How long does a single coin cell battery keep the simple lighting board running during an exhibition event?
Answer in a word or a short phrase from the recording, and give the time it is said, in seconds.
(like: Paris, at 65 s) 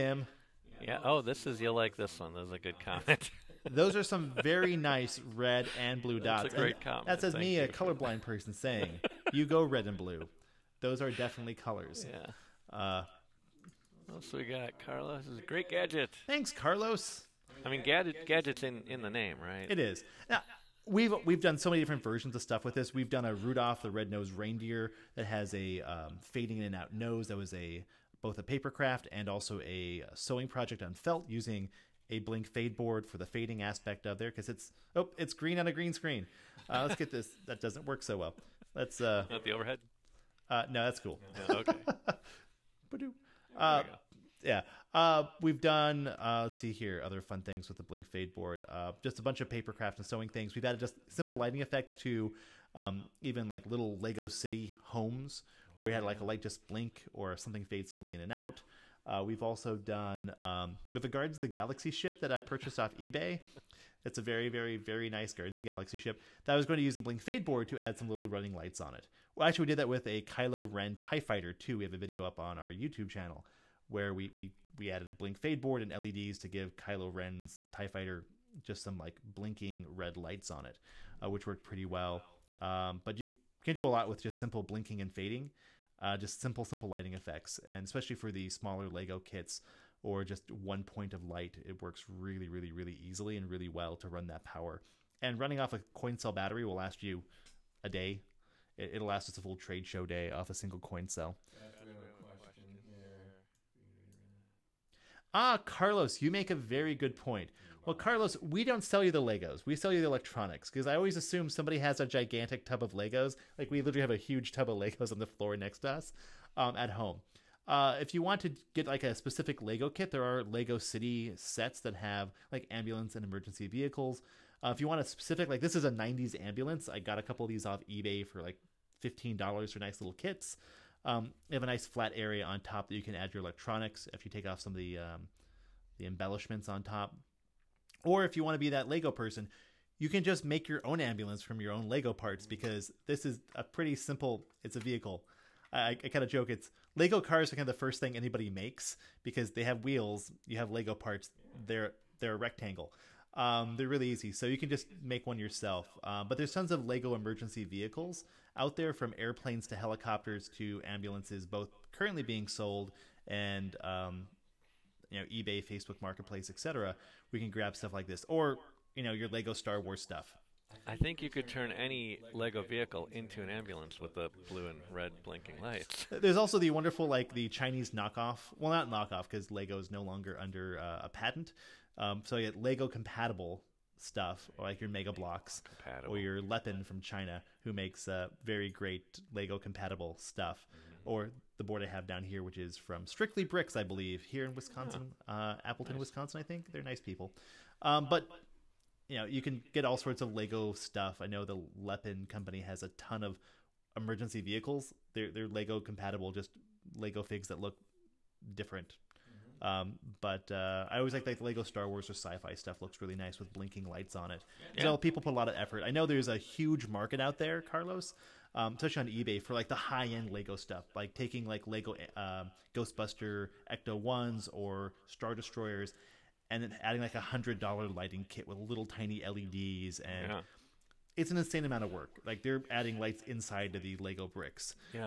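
a full trade show day, at 99 s.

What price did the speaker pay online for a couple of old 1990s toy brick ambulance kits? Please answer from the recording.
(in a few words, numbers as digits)
$15.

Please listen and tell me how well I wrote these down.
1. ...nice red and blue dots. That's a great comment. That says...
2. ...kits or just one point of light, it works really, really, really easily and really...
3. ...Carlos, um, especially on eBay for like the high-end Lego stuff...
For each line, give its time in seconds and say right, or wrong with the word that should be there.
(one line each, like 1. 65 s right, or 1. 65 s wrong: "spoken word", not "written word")
1. 4 s right
2. 89 s right
3. 217 s right.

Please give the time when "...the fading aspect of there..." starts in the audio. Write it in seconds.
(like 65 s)
33 s.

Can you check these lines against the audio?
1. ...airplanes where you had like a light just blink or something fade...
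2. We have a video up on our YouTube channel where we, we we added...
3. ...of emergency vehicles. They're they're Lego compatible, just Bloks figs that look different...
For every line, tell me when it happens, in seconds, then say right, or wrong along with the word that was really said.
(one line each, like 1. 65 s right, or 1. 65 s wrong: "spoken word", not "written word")
1. 54 s wrong: "homes", not "airplanes"
2. 71 s right
3. 203 s wrong: "Lego", not "Bloks".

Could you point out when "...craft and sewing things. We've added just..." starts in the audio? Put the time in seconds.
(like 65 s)
49 s.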